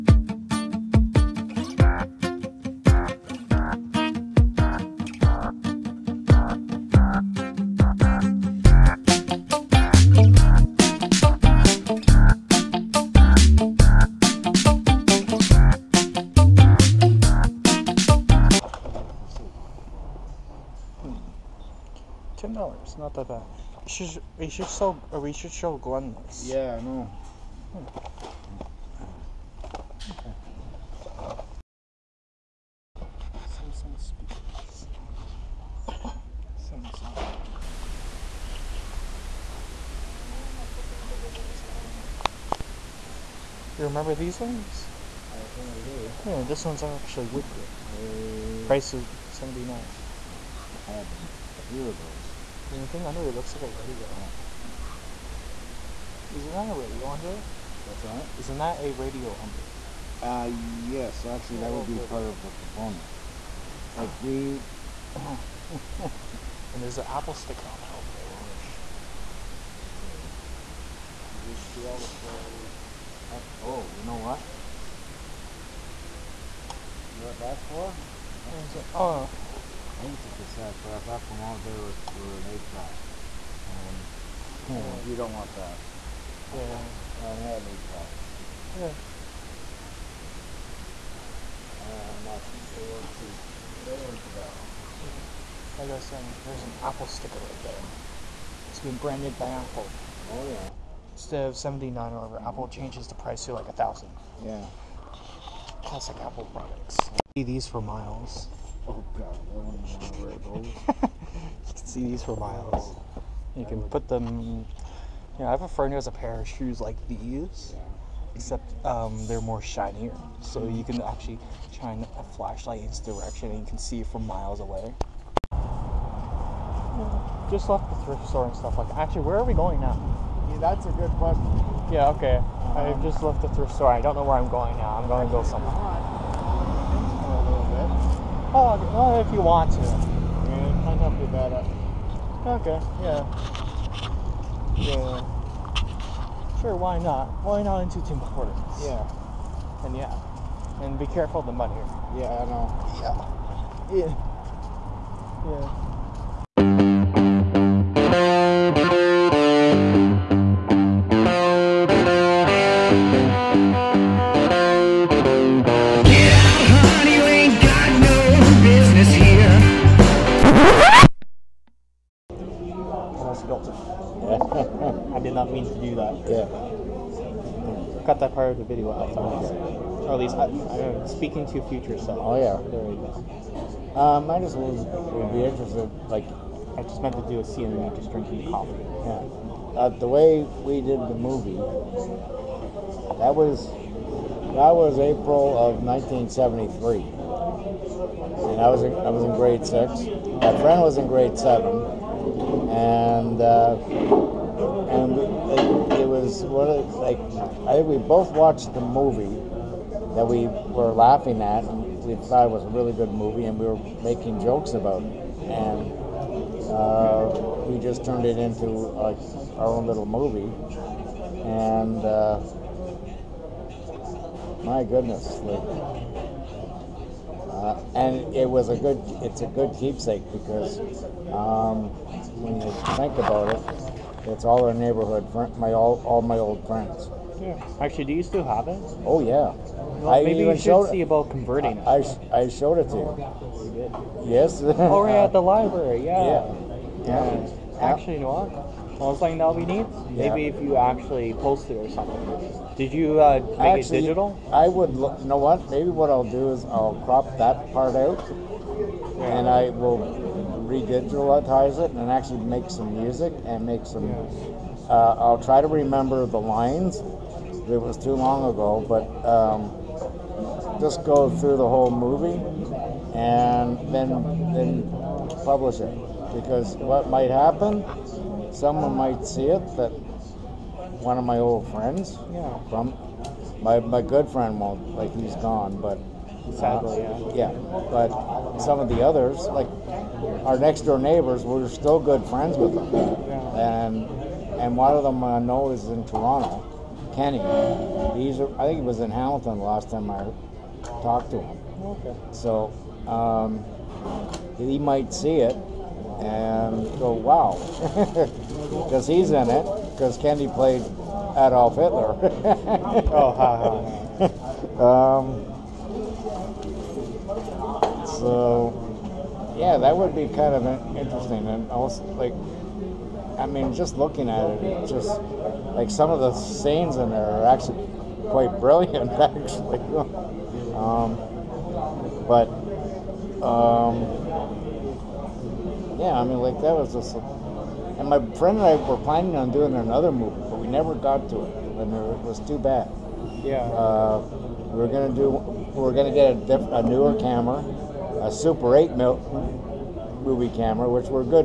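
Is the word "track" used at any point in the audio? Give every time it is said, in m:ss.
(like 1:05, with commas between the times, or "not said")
1:22, 1:27.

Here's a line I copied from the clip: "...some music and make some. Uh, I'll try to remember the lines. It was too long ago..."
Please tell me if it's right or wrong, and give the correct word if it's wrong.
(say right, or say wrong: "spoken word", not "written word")
right.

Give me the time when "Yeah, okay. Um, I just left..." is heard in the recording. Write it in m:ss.
2:11.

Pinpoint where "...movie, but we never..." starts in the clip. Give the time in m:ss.
5:40.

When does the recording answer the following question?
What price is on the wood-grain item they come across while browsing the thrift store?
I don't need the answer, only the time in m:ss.
0:48.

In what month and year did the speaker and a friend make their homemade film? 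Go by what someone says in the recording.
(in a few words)
April 1973.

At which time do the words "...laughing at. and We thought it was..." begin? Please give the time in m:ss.
3:30.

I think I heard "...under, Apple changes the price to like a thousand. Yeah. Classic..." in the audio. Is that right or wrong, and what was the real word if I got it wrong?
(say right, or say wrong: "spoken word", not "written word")
wrong: "whatever", not "under".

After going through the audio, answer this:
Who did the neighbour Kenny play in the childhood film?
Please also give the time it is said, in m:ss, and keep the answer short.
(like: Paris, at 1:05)
Adolf Hitler, at 5:11.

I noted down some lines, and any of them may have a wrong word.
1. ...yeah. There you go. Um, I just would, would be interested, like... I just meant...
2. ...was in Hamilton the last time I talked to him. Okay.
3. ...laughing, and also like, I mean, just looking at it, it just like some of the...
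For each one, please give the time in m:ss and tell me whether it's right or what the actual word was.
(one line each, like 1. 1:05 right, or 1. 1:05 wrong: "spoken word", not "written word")
1. 3:02 right
2. 4:58 right
3. 5:20 wrong: "interesting", not "laughing".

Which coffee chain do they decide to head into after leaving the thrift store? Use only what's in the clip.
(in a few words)
Tim Hortons.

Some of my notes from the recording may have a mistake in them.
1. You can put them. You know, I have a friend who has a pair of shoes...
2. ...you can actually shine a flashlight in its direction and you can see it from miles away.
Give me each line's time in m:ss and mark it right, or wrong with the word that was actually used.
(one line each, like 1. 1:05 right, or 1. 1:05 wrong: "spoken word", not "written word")
1. 1:53 right
2. 2:00 right.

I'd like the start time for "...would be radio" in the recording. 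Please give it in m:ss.
1:01.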